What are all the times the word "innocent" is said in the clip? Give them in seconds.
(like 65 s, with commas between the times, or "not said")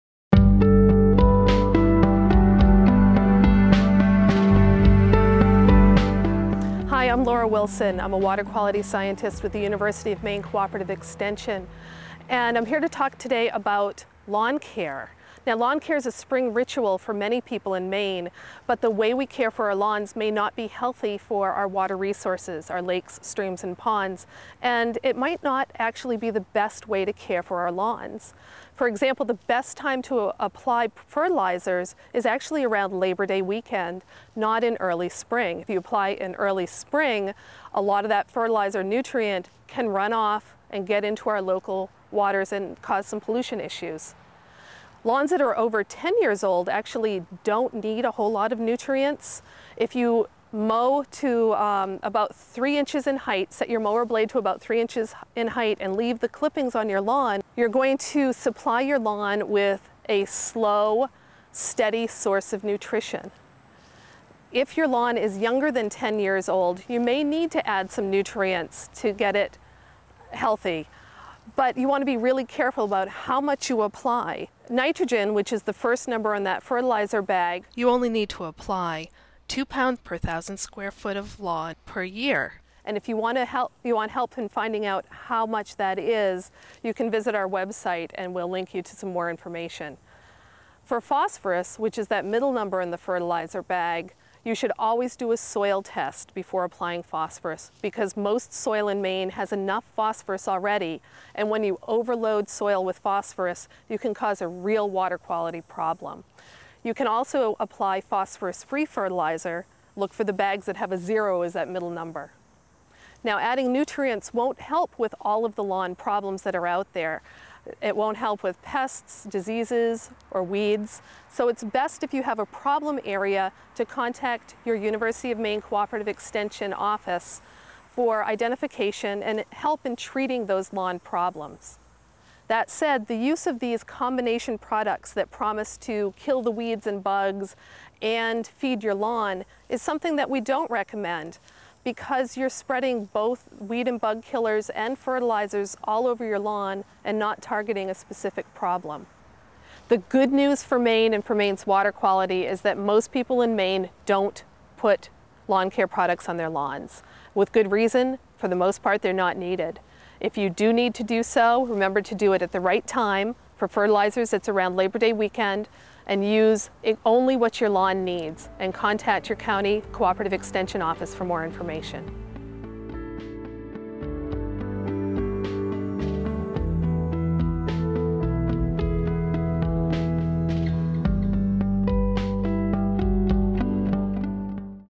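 not said.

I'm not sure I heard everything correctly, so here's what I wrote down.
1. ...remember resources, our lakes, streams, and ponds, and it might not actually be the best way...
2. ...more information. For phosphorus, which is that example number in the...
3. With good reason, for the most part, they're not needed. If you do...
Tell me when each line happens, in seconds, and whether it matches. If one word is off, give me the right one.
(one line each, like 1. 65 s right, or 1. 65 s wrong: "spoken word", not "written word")
1. 21 s wrong: "water", not "remember"
2. 89 s wrong: "middle", not "example"
3. 157 s right.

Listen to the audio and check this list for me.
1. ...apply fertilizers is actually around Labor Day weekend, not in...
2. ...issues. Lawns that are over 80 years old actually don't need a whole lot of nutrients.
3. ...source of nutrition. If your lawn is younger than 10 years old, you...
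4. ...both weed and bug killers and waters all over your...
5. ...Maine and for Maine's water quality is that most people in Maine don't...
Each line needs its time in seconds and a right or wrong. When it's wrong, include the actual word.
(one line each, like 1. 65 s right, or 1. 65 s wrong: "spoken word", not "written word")
1. 30 s right
2. 43 s wrong: "10", not "80"
3. 62 s right
4. 143 s wrong: "fertilizers", not "waters"
5. 150 s right.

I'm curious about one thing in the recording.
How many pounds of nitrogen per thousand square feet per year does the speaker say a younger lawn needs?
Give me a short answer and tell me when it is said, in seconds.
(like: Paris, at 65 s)
2 pounds, at 79 s.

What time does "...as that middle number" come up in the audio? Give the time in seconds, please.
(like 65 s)
111 s.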